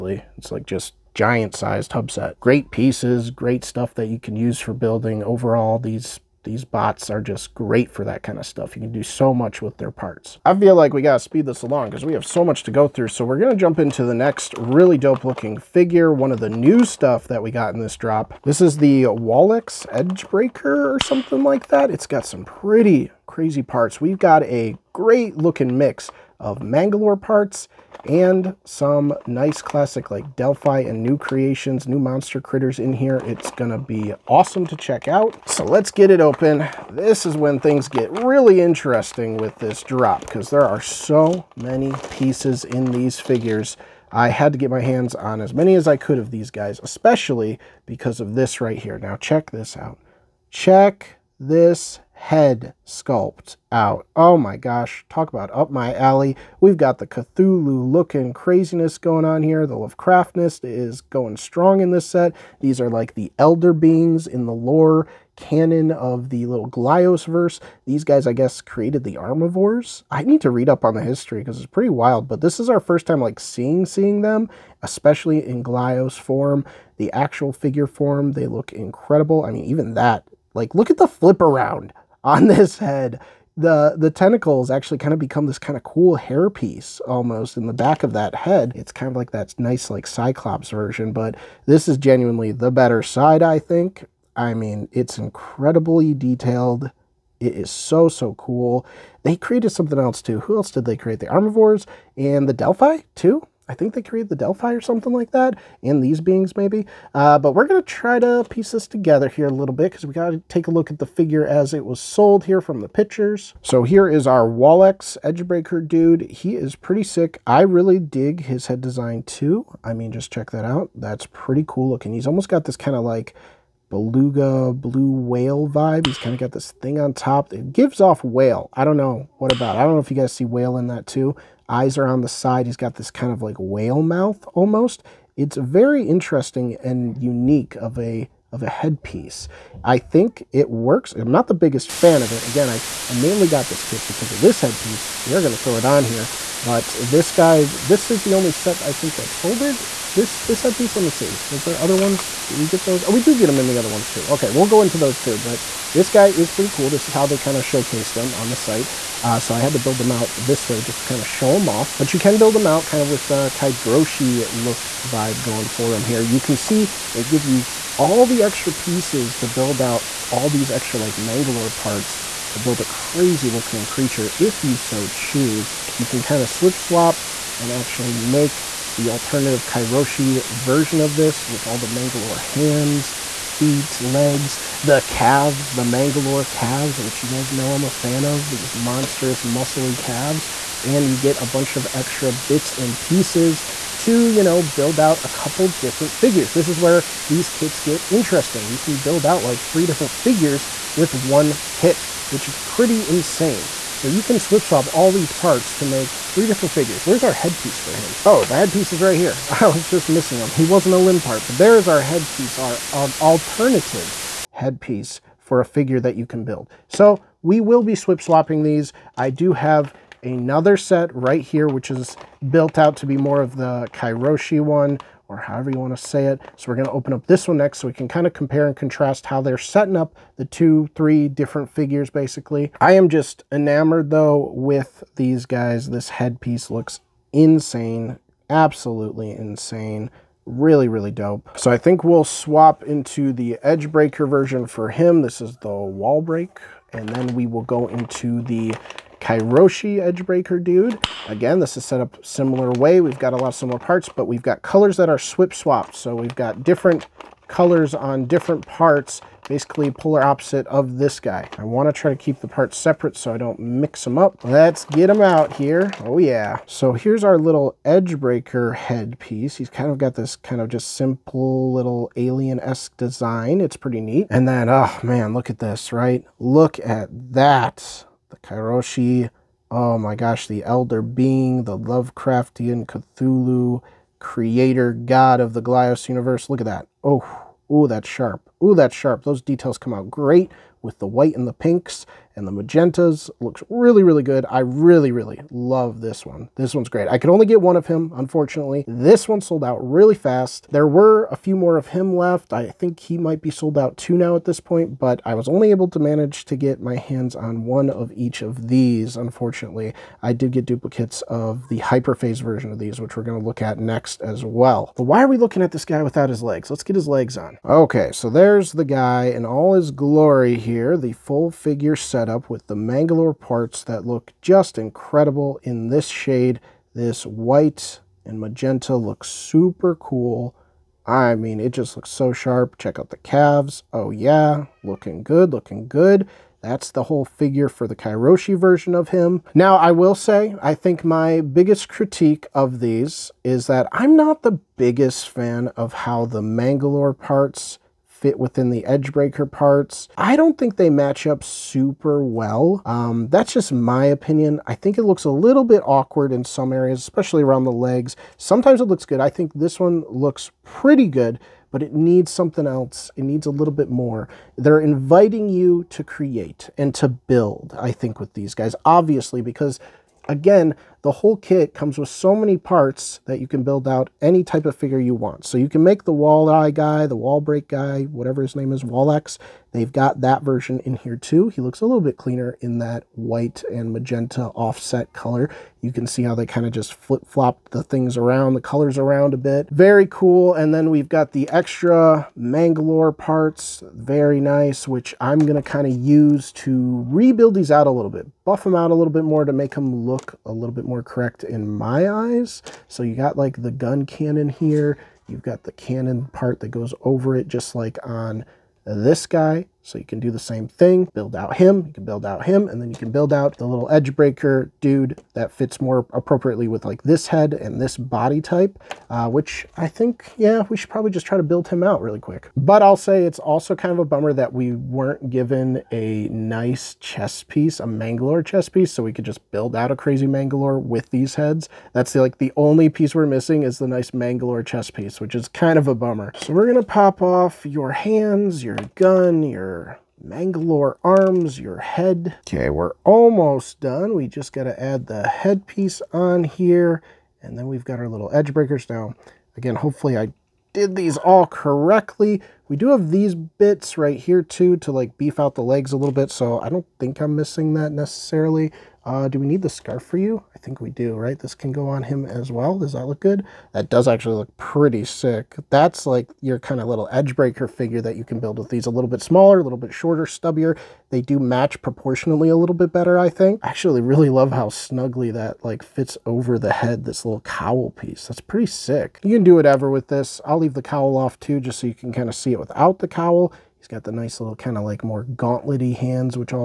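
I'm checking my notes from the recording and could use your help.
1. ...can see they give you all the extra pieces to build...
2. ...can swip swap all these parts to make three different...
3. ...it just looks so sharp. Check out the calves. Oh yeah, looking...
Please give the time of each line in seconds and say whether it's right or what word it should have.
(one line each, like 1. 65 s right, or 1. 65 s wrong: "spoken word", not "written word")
1. 166 s right
2. 204 s right
3. 331 s right.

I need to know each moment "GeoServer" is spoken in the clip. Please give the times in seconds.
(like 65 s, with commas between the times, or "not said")
not said.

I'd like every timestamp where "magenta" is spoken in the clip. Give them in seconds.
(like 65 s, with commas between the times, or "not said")
292 s, 328 s, 383 s.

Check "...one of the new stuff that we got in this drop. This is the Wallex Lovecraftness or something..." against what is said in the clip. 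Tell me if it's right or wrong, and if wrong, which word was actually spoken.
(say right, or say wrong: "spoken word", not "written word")
wrong: "Edgebreaker", not "Lovecraftness".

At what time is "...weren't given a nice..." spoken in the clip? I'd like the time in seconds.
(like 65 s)
424 s.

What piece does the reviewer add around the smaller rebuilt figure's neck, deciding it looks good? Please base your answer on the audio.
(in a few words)
The scarf.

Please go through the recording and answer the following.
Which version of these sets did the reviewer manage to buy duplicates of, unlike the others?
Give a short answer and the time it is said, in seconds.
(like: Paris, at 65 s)
Hyperphase, at 311 s.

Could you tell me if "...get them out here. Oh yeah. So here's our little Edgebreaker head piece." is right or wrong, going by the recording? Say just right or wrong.
right.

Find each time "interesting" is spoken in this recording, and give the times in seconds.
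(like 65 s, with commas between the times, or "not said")
38 s, 136 s, 198 s.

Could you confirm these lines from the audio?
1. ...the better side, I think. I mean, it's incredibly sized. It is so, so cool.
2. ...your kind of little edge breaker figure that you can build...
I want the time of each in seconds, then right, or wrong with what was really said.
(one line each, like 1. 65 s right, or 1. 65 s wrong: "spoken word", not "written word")
1. 92 s wrong: "detailed", not "sized"
2. 466 s right.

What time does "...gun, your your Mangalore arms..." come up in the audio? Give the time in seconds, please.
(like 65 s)
438 s.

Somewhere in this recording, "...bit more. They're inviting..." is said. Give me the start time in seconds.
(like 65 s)
363 s.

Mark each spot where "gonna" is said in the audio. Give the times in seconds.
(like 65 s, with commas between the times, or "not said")
13 s, 33 s, 436 s.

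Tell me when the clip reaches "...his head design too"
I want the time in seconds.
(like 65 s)
118 s.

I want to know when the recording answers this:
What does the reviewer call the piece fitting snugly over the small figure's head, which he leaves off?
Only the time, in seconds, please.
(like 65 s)
477 s.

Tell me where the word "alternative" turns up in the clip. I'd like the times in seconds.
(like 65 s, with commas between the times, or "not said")
179 s, 213 s.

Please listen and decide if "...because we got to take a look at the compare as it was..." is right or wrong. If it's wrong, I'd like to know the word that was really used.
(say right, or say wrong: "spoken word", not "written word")
wrong: "figure", not "compare".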